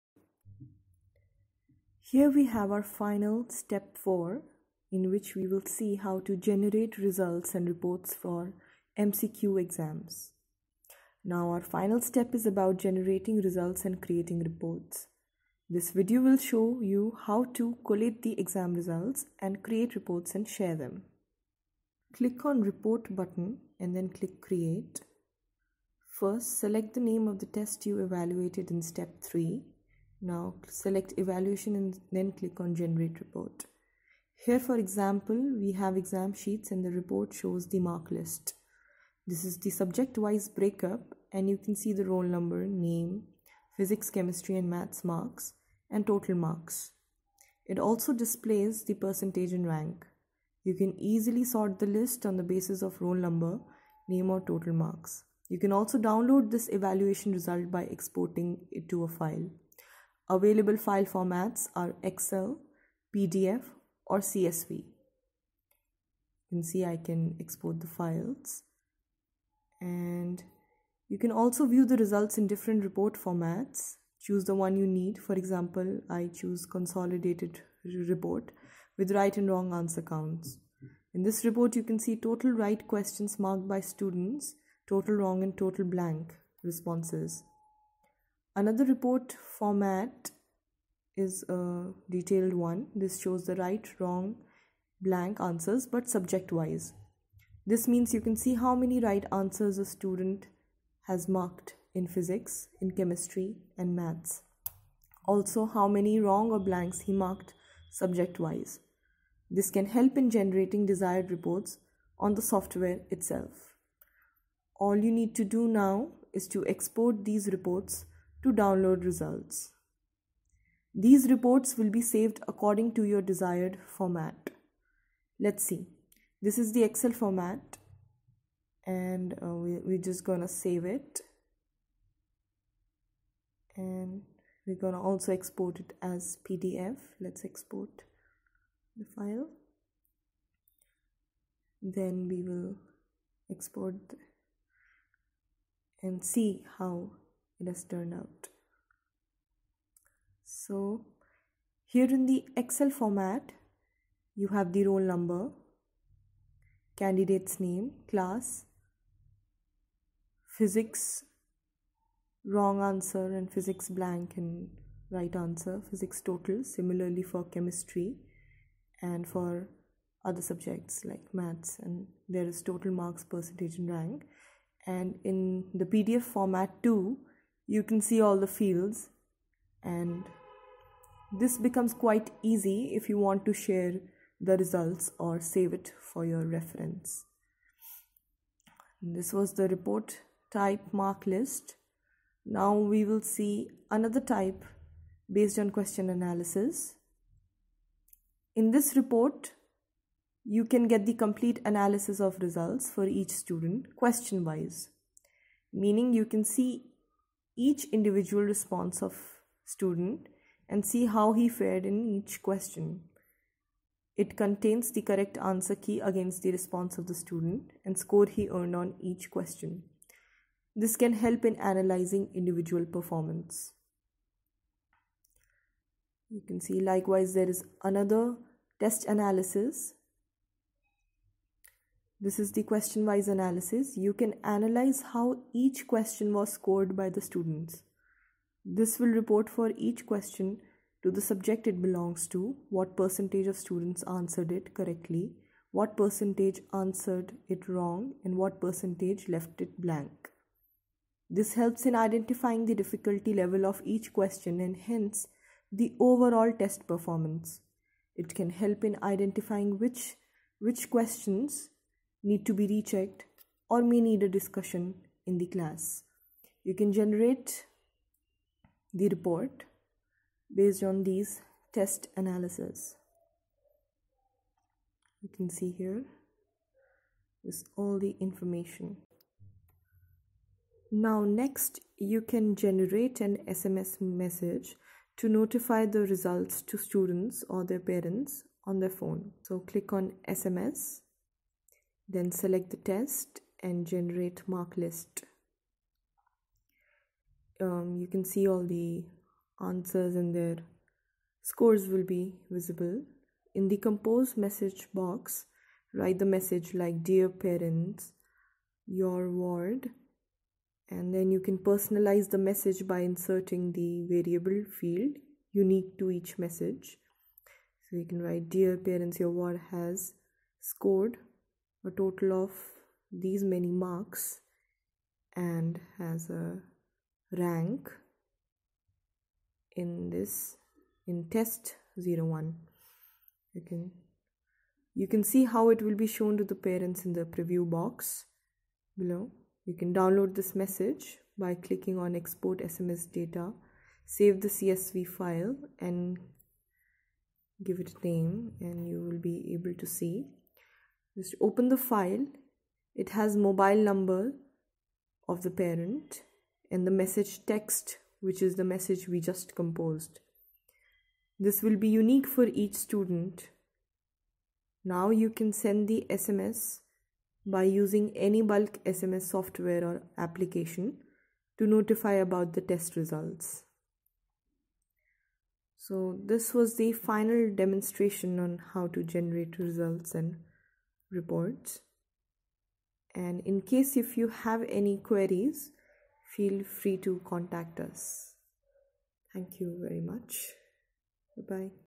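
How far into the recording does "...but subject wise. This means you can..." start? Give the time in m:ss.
1:35.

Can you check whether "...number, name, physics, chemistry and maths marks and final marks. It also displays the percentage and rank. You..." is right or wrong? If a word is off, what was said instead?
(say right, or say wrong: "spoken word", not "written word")
wrong: "total", not "final".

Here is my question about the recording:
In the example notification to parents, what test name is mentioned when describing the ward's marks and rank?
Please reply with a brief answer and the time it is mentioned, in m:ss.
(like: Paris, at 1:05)
test 01, at 5:31.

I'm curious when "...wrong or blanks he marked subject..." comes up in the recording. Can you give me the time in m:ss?
1:46.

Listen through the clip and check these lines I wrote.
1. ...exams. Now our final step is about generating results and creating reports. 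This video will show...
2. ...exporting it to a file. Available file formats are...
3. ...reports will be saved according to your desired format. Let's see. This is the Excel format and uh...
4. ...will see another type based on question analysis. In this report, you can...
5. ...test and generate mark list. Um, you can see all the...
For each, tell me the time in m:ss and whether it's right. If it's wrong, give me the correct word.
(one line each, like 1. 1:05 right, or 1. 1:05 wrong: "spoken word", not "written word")
1. 0:09 right
2. 0:57 right
3. 2:01 right
4. 3:13 right
5. 4:52 right.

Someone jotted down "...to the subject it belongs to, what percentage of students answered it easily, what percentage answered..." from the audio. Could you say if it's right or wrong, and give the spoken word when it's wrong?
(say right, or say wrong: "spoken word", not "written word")
wrong: "correctly", not "easily".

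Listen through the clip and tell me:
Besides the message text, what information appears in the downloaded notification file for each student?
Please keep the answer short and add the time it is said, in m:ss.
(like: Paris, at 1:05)
mobile number of the parent, at 5:53.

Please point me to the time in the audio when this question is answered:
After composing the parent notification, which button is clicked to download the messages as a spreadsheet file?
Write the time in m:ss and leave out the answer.
5:42.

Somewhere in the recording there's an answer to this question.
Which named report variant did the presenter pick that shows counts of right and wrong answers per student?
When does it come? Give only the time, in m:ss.
1:16.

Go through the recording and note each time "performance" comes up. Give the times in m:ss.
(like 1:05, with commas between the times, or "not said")
3:42, 4:16.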